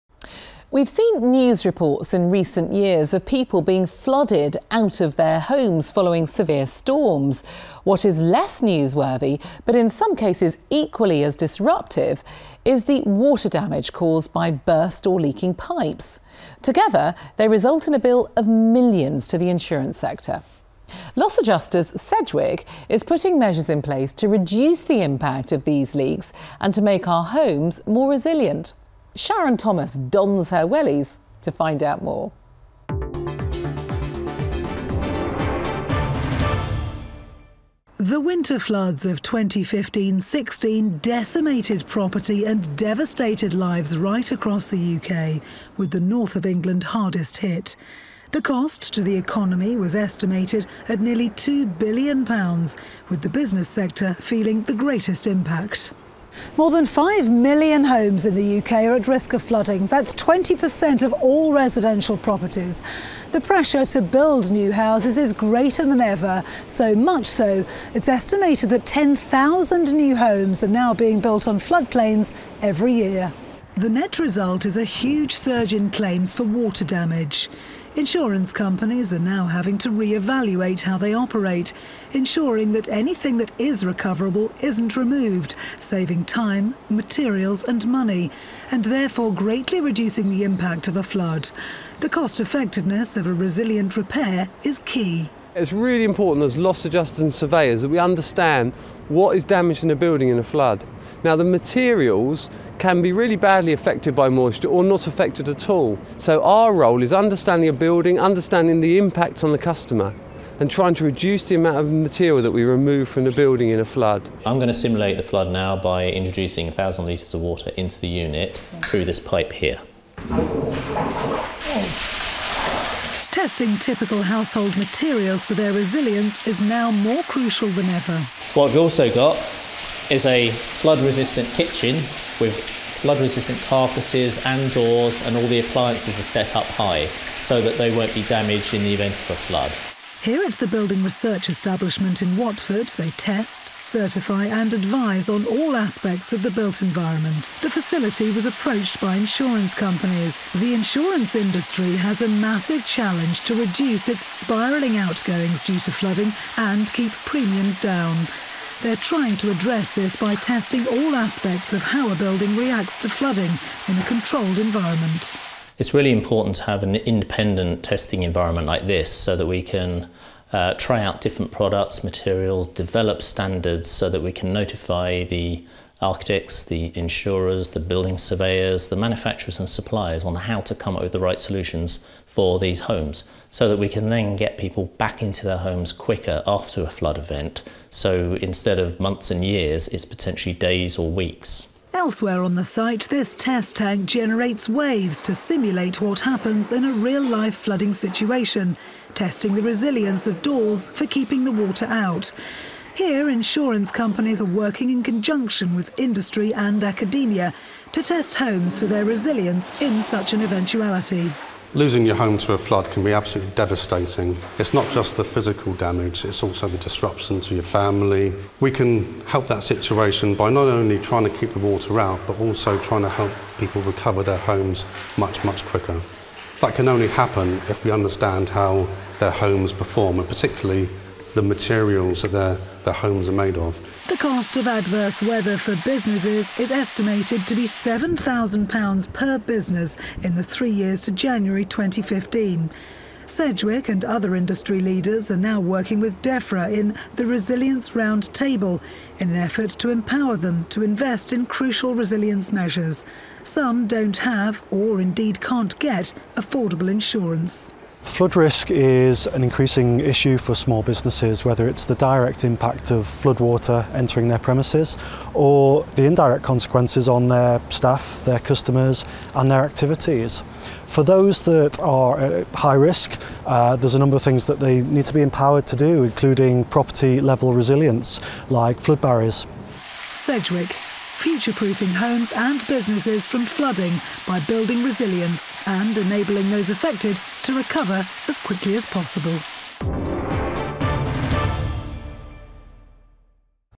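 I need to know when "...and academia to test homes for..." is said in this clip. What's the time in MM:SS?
03:26.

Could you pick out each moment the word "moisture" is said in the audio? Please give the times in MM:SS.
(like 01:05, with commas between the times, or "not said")
01:44.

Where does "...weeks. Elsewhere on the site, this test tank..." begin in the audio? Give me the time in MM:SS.
03:11.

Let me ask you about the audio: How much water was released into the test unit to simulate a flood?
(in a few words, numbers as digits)
1,000 litres.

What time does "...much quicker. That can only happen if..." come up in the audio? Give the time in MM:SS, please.
03:45.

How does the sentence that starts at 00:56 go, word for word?
More than 5 million homes in the UK are at risk of flooding.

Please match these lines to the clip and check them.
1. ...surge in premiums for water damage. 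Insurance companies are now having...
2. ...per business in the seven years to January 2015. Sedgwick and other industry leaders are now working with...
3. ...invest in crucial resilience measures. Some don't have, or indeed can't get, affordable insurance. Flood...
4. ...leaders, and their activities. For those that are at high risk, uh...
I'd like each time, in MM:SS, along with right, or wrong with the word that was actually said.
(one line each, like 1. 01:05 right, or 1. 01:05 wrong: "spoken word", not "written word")
1. 01:15 wrong: "claims", not "premiums"
2. 03:59 wrong: "three", not "seven"
3. 04:10 right
4. 04:28 wrong: "customers", not "leaders".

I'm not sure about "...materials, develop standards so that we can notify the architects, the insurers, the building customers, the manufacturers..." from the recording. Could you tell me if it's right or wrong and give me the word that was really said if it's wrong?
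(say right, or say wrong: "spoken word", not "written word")
wrong: "surveyors", not "customers".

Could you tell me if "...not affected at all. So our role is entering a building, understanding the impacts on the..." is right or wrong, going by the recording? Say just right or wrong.
wrong.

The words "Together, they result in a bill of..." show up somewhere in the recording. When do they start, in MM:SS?
00:16.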